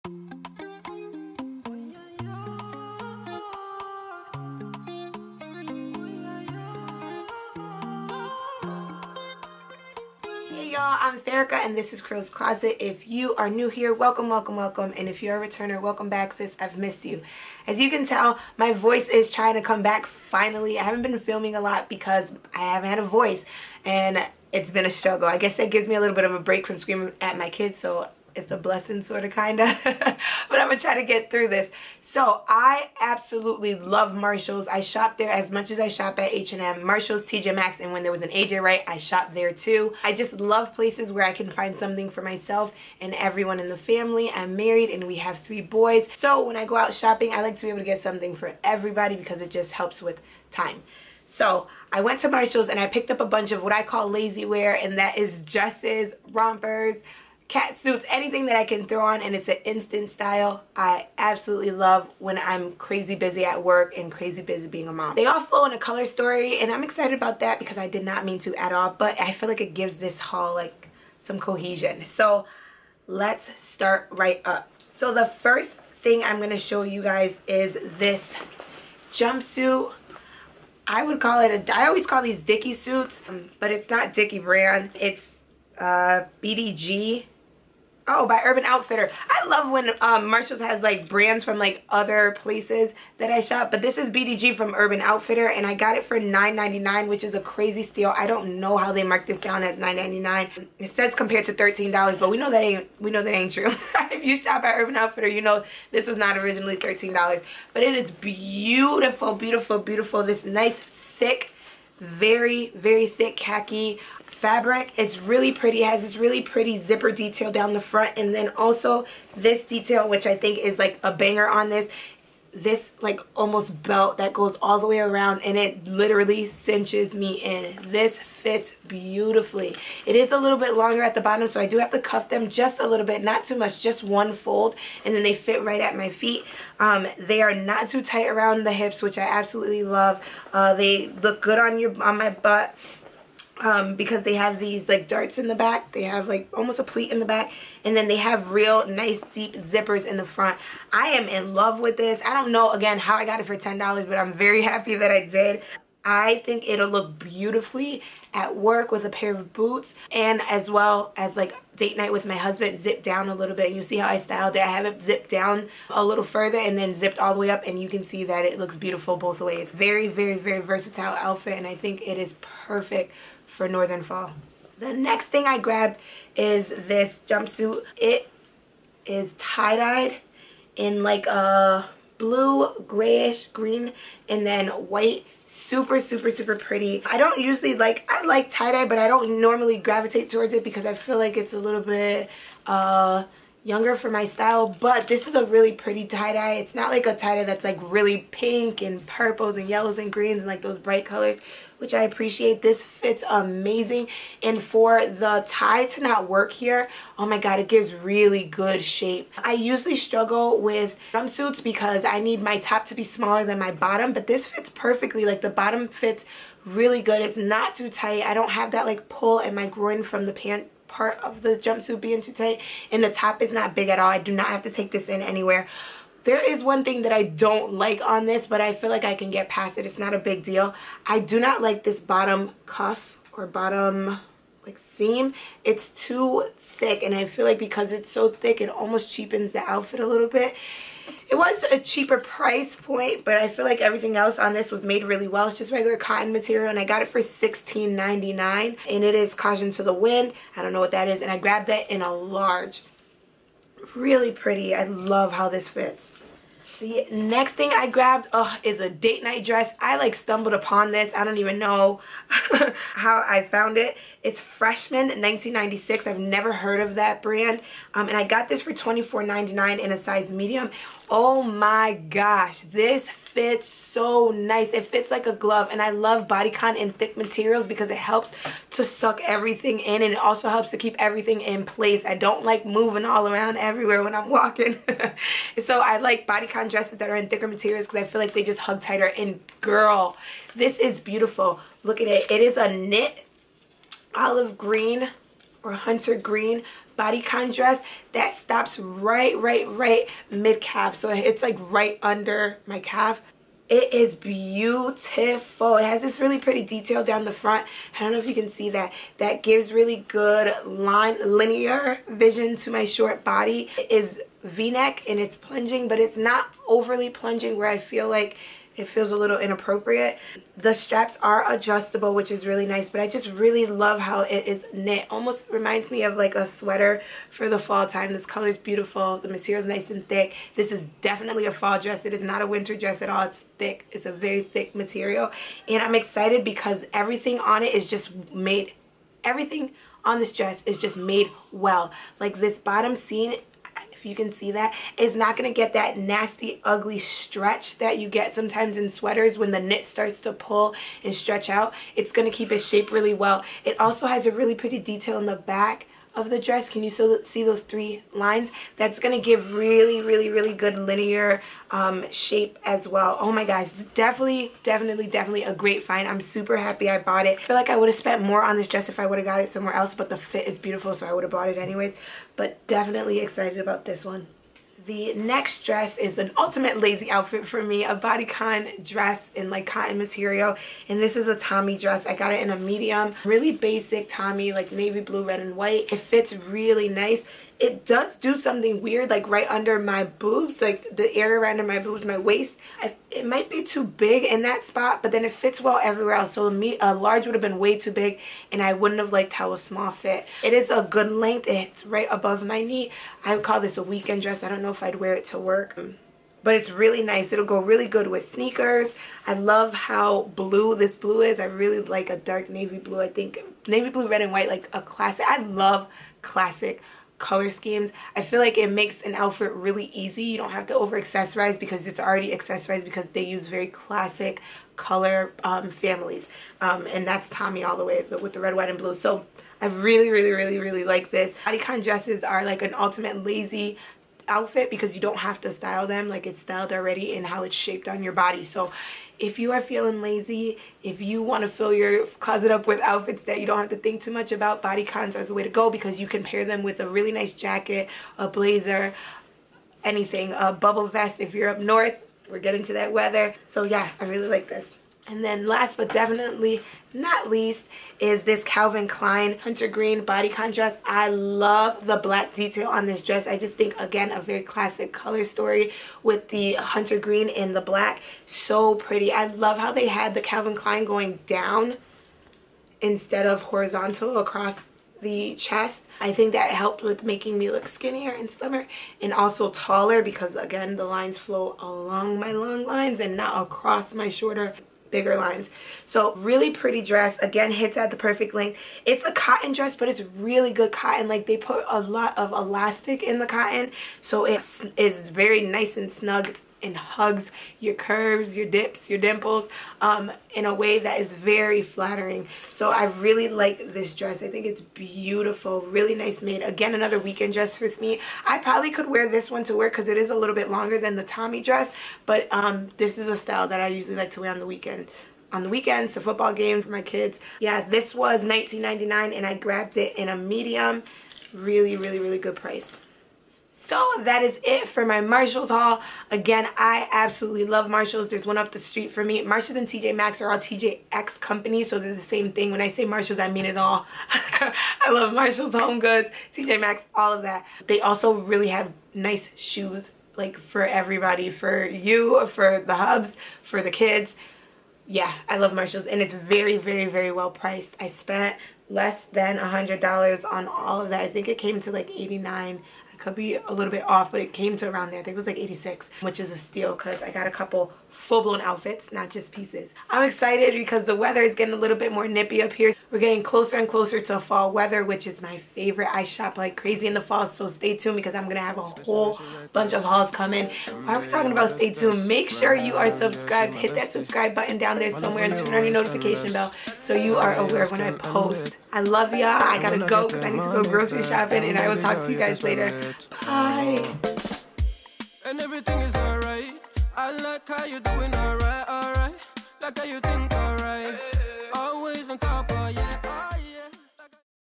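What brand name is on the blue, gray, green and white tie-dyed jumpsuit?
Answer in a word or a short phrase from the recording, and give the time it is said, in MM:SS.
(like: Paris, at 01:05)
Caution to the Wind, at 04:09.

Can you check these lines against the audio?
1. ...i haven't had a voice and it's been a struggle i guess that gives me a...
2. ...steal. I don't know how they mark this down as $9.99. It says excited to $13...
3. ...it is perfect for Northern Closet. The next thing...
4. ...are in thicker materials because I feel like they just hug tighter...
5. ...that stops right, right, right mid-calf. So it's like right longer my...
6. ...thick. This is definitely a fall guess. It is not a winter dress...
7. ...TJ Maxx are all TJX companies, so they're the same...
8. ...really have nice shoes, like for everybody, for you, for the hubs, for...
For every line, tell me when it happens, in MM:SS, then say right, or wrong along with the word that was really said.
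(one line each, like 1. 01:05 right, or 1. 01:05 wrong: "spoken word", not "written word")
1. 00:22 right
2. 01:37 wrong: "compared", not "excited"
3. 02:52 wrong: "Fall", not "Closet"
4. 04:47 right
5. 04:58 wrong: "under", not "longer"
6. 05:30 wrong: "dress", not "guess"
7. 08:49 right
8. 08:58 right.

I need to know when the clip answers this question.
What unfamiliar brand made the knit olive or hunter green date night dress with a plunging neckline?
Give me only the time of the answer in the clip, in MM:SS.
04:24.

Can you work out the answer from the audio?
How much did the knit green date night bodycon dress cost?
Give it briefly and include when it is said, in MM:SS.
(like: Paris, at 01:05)
$24.99, at 04:28.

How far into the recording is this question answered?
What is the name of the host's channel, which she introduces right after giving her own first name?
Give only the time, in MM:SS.
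00:12.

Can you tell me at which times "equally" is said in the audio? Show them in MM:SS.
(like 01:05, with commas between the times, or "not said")
not said.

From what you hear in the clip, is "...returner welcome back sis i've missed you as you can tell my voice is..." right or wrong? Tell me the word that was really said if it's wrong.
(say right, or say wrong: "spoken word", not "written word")
right.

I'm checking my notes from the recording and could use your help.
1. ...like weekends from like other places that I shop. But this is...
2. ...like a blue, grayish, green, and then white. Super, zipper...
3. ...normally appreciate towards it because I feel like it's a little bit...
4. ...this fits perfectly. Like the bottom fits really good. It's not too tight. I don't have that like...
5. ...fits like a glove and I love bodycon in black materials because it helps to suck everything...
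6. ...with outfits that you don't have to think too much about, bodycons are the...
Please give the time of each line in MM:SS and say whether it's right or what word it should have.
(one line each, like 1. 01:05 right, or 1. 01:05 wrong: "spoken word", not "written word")
1. 01:30 wrong: "brands", not "weekends"
2. 03:01 wrong: "super", not "zipper"
3. 03:09 wrong: "gravitate", not "appreciate"
4. 03:34 right
5. 04:34 wrong: "thick", not "black"
6. 07:22 right.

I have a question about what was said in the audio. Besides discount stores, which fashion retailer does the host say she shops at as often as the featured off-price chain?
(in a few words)
H&M.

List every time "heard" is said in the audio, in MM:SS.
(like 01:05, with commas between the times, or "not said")
04:26.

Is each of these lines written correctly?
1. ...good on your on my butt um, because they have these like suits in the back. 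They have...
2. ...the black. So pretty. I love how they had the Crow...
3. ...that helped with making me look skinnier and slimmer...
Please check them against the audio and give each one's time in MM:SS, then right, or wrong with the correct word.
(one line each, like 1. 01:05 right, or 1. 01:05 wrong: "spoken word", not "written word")
1. 02:21 wrong: "darts", not "suits"
2. 07:47 wrong: "Calvin", not "Crow"
3. 07:56 right.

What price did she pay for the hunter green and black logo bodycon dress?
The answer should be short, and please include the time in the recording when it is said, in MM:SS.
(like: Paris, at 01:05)
$19.99, at 08:38.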